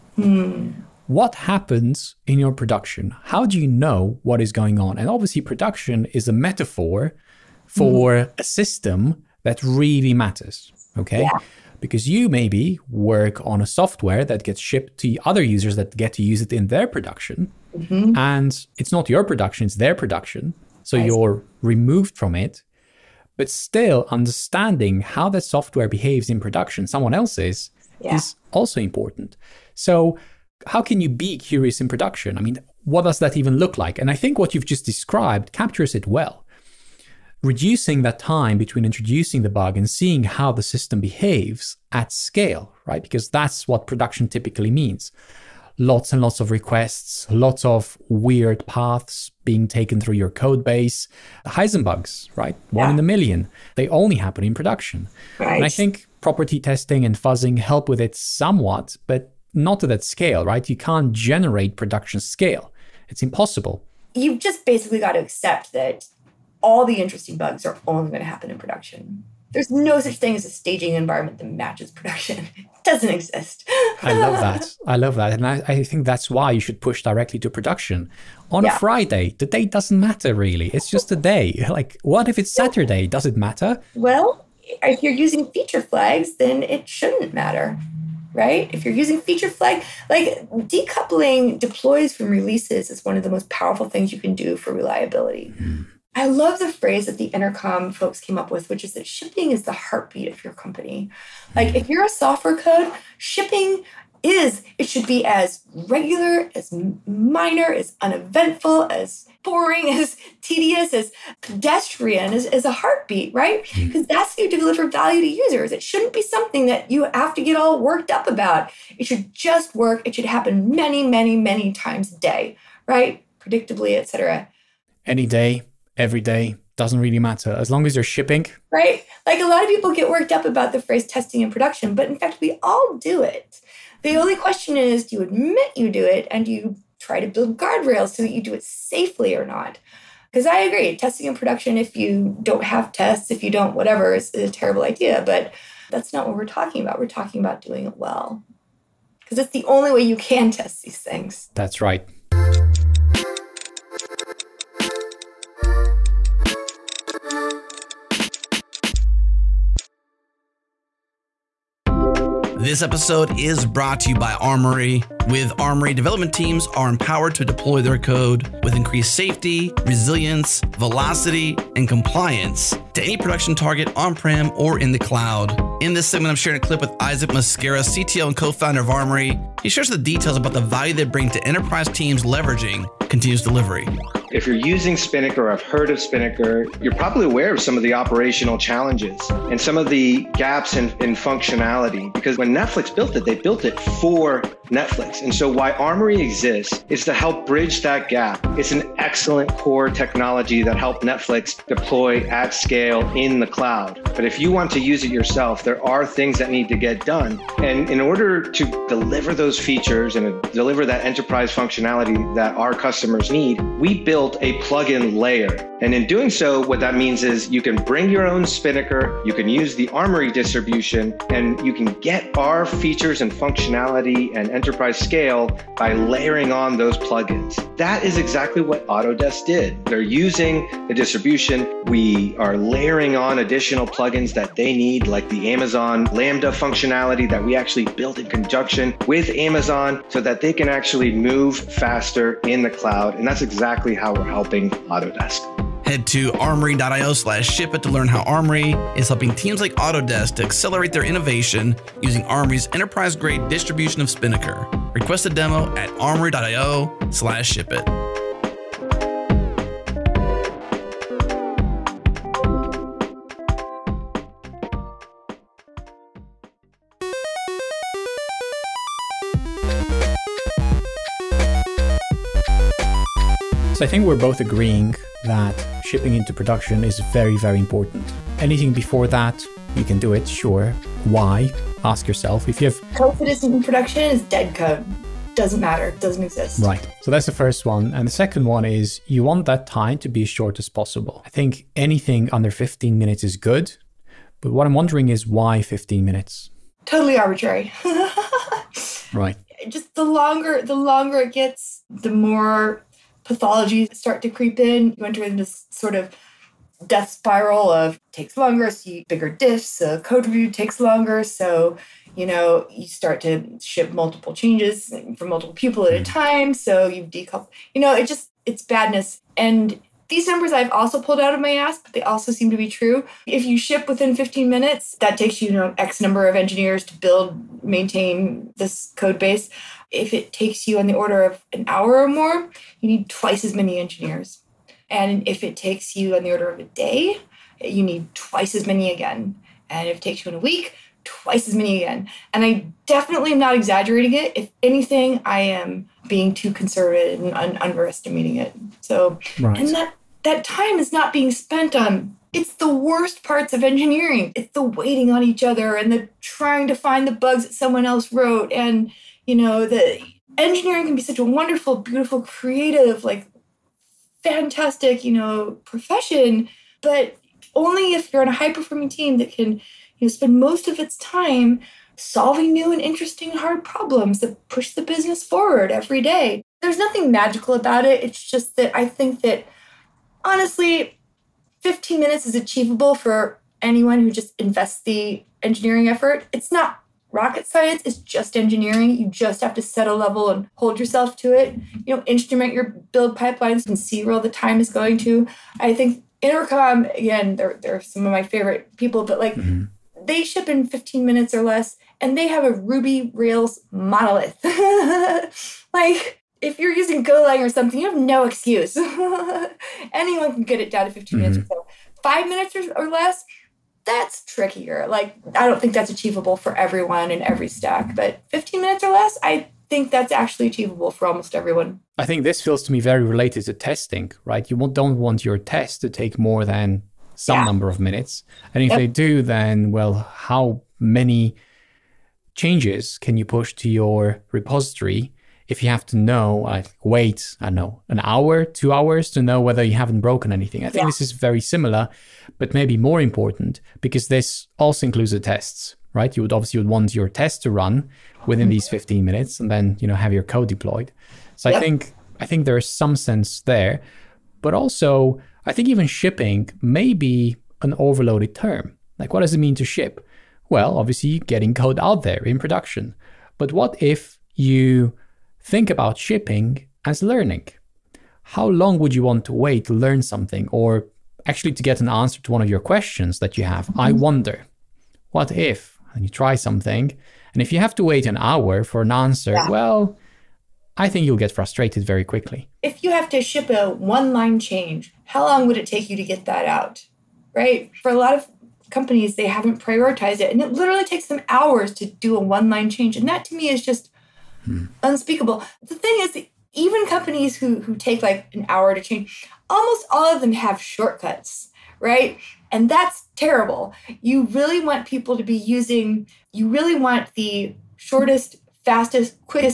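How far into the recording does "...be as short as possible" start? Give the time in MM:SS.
04:50.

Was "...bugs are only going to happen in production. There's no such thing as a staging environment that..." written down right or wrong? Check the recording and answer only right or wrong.
right.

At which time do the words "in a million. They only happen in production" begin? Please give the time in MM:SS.
00:52.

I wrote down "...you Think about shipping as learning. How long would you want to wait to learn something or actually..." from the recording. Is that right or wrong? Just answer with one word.
right.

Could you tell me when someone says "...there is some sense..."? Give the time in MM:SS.
07:32.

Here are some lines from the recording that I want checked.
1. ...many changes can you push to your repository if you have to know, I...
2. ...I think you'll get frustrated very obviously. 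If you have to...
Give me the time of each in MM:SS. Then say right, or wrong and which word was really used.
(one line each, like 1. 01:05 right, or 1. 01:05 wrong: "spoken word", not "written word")
1. 07:10 right
2. 08:00 wrong: "quickly", not "obviously".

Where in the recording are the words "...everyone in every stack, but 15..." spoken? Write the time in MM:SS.
06:56.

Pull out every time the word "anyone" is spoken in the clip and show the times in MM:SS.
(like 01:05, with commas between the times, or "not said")
06:23, 06:49.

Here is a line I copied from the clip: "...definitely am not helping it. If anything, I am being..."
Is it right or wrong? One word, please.
wrong.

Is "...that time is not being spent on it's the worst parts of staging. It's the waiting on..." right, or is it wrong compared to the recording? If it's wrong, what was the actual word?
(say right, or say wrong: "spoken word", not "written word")
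wrong: "engineering", not "staging".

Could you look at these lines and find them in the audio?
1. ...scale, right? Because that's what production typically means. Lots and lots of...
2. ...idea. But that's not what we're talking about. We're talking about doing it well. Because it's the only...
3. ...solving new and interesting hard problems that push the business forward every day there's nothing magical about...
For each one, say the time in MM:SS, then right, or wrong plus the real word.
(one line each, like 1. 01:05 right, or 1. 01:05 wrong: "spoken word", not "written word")
1. 00:42 right
2. 02:24 right
3. 06:11 right.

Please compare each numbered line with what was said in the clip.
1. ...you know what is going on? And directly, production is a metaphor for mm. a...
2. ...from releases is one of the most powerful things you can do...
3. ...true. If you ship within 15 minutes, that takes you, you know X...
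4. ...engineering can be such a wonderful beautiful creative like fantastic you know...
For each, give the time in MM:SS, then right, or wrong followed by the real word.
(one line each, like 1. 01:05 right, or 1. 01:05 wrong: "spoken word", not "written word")
1. 00:03 wrong: "obviously", not "directly"
2. 01:32 right
3. 05:22 right
4. 06:00 right.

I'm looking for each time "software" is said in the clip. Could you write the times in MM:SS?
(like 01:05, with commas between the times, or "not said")
00:13, 00:25, 01:42.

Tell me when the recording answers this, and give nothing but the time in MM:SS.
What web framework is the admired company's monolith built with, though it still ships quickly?
06:42.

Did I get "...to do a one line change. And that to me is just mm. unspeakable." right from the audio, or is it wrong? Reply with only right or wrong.
right.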